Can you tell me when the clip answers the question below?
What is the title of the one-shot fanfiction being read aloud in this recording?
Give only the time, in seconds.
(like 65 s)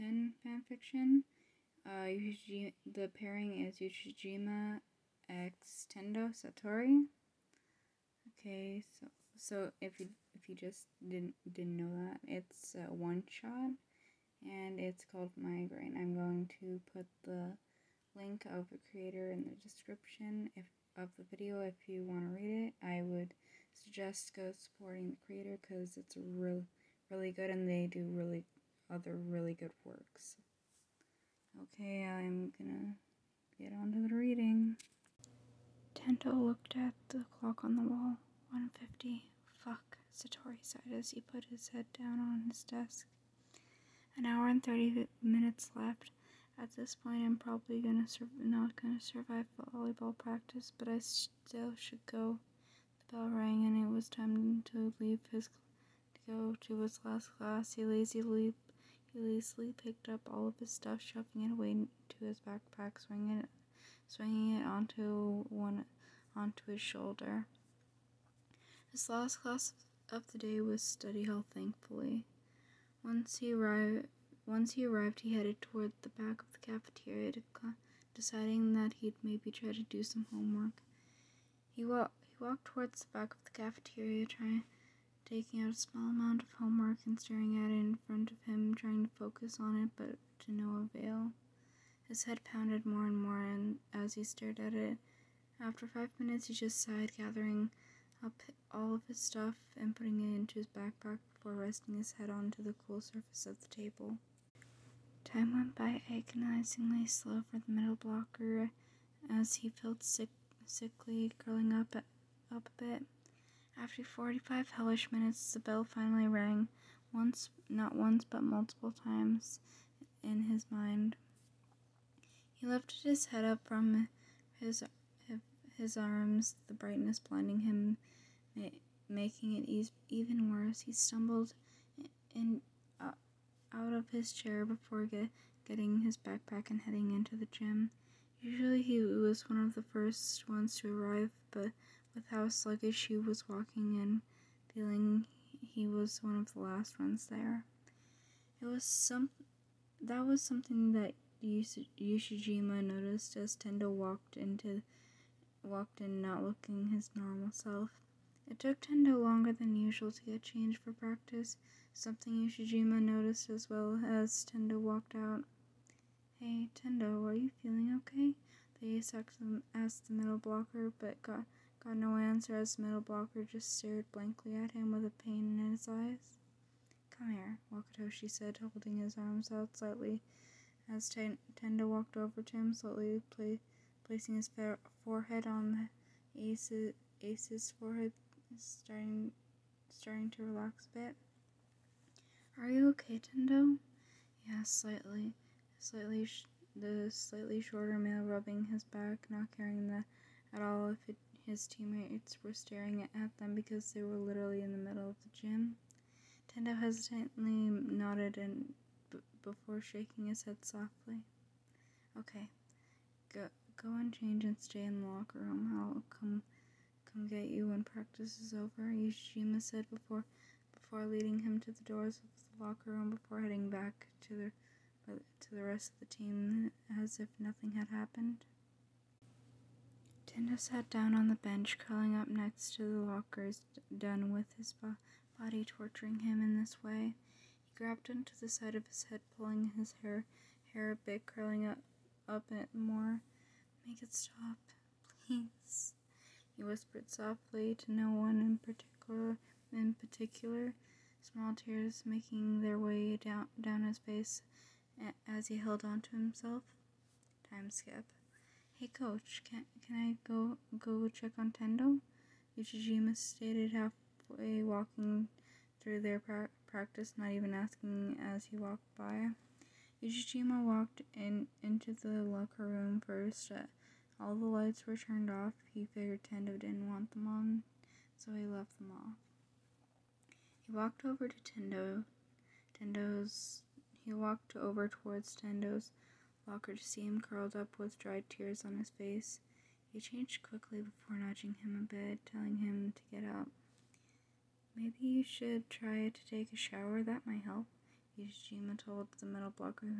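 15 s.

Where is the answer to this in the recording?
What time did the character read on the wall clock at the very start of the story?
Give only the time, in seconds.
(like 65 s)
38 s.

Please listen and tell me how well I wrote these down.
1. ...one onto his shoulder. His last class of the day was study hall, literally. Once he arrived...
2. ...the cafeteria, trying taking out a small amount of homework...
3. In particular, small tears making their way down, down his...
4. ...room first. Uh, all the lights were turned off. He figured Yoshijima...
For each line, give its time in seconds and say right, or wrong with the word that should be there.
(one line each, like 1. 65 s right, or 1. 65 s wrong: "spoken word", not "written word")
1. 65 s wrong: "thankfully", not "literally"
2. 83 s right
3. 249 s right
4. 272 s wrong: "Tendo", not "Yoshijima".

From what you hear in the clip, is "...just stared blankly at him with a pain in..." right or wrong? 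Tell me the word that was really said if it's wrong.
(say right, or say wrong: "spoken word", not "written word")
right.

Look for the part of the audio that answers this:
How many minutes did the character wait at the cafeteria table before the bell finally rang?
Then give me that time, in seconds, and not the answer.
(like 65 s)
114 s.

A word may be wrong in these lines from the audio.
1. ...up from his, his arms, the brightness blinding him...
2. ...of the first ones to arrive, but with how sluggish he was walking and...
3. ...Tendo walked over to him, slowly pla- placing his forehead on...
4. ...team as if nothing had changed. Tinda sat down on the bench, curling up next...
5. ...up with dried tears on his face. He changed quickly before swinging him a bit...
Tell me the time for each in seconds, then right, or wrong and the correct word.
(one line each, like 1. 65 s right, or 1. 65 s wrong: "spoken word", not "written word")
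1. 123 s right
2. 139 s right
3. 181 s right
4. 226 s wrong: "happened", not "changed"
5. 287 s wrong: "nudging", not "swinging".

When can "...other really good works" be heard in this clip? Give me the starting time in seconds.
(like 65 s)
28 s.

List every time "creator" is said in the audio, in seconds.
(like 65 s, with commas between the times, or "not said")
18 s, 25 s.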